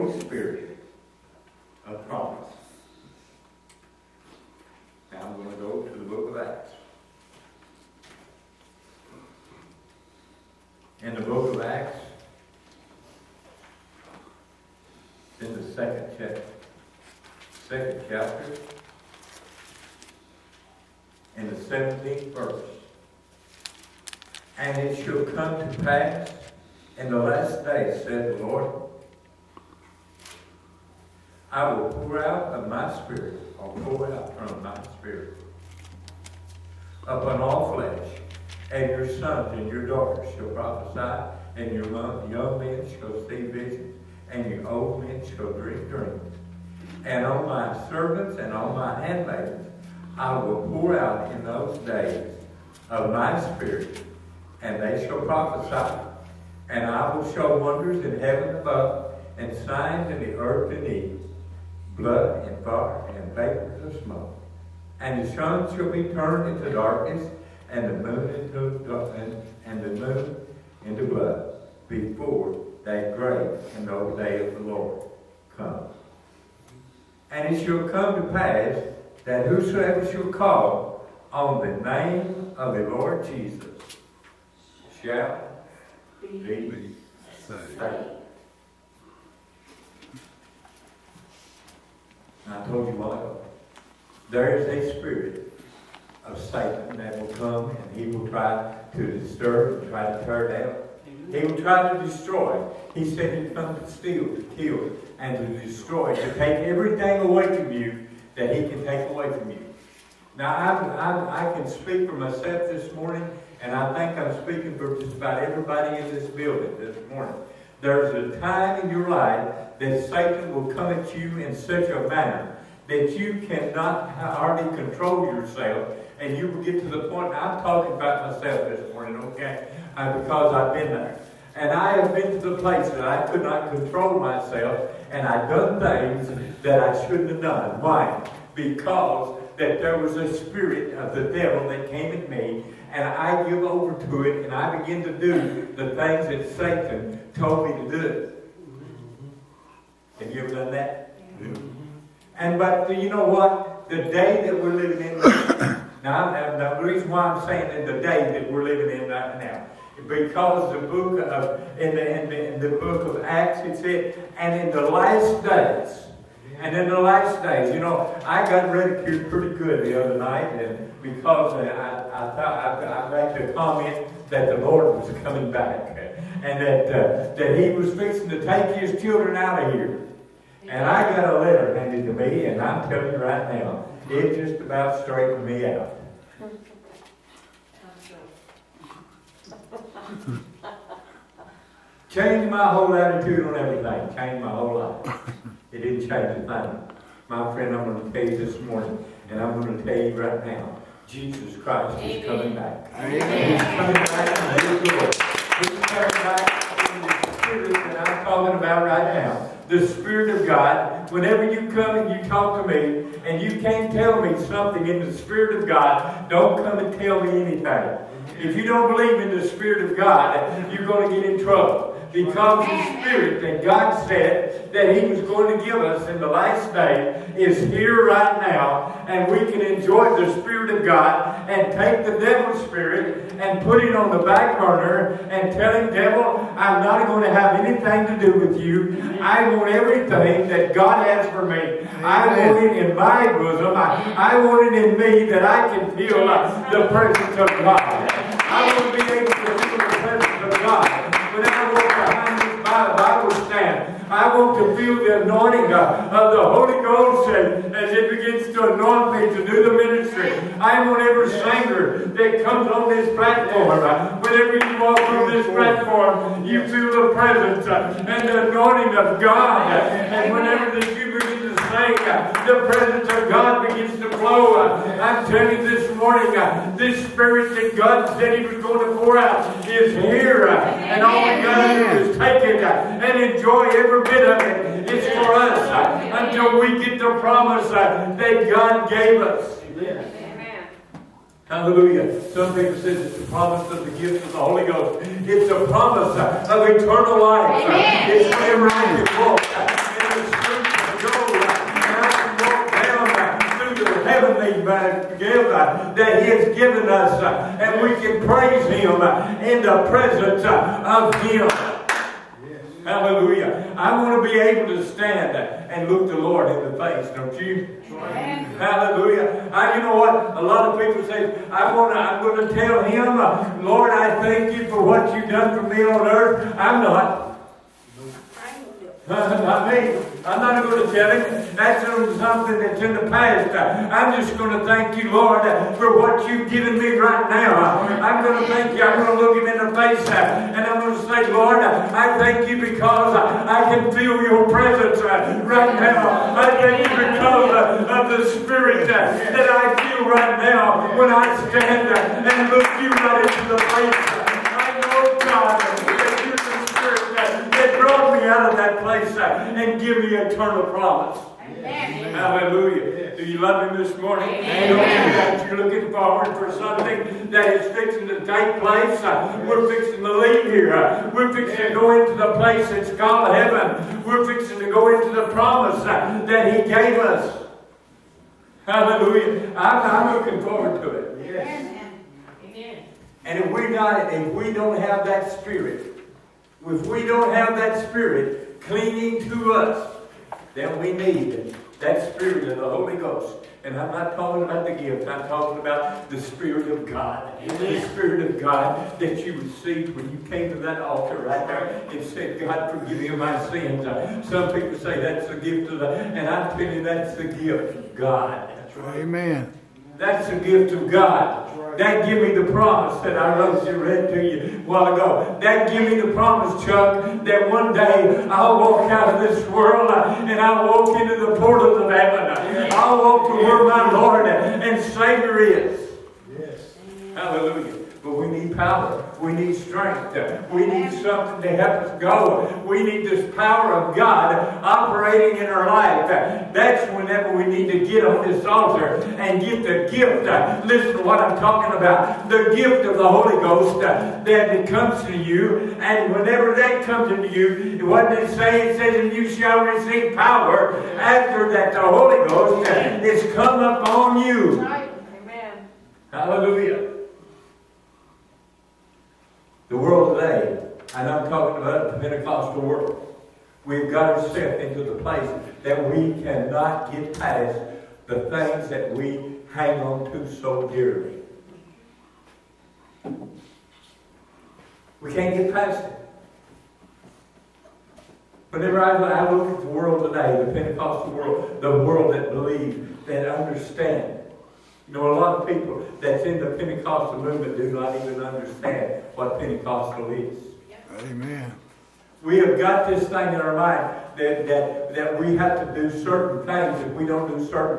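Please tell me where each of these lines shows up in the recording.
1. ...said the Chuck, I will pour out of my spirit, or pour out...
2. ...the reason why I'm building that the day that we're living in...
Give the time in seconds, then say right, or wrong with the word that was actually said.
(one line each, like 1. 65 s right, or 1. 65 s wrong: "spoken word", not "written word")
1. 28 s wrong: "Lord", not "Chuck"
2. 156 s wrong: "saying", not "building".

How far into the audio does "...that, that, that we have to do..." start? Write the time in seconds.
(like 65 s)
494 s.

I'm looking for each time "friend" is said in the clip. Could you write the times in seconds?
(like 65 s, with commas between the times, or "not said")
197 s.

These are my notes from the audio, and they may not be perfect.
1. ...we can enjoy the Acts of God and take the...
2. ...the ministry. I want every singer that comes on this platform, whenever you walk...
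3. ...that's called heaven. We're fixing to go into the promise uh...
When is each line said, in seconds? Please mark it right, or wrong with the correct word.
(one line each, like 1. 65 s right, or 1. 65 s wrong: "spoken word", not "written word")
1. 229 s wrong: "Spirit", not "Acts"
2. 259 s right
3. 372 s right.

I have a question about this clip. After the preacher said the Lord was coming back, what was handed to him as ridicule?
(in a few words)
a letter.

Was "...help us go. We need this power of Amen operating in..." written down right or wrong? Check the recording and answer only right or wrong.
wrong.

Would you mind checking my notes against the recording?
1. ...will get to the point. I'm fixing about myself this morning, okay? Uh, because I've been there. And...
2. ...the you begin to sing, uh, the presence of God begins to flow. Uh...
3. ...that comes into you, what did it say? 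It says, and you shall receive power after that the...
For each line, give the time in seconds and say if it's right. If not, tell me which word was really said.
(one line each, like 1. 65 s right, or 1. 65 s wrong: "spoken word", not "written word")
1. 126 s wrong: "talking", not "fixing"
2. 270 s right
3. 446 s right.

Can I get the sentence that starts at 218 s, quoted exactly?
If you don't believe in the Spirit of God, you're going to get in trouble.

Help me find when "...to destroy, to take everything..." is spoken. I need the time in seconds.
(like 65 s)
105 s.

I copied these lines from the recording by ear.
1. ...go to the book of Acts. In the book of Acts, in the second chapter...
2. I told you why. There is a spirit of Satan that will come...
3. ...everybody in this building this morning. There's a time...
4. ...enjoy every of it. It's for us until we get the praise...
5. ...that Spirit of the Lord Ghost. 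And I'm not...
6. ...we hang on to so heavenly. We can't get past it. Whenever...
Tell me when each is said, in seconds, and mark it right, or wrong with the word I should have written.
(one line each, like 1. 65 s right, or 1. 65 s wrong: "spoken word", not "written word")
1. 5 s right
2. 92 s right
3. 115 s right
4. 283 s wrong: "promise", not "praise"
5. 391 s wrong: "Holy", not "Lord"
6. 468 s wrong: "dearly", not "heavenly".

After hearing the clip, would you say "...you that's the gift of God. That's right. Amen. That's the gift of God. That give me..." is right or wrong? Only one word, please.
right.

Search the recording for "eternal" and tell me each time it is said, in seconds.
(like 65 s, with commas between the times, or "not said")
296 s, 360 s.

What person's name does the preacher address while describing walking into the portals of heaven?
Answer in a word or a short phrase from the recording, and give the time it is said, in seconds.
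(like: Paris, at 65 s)
Chuck, at 416 s.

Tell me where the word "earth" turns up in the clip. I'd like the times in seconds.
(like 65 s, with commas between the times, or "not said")
60 s, 326 s.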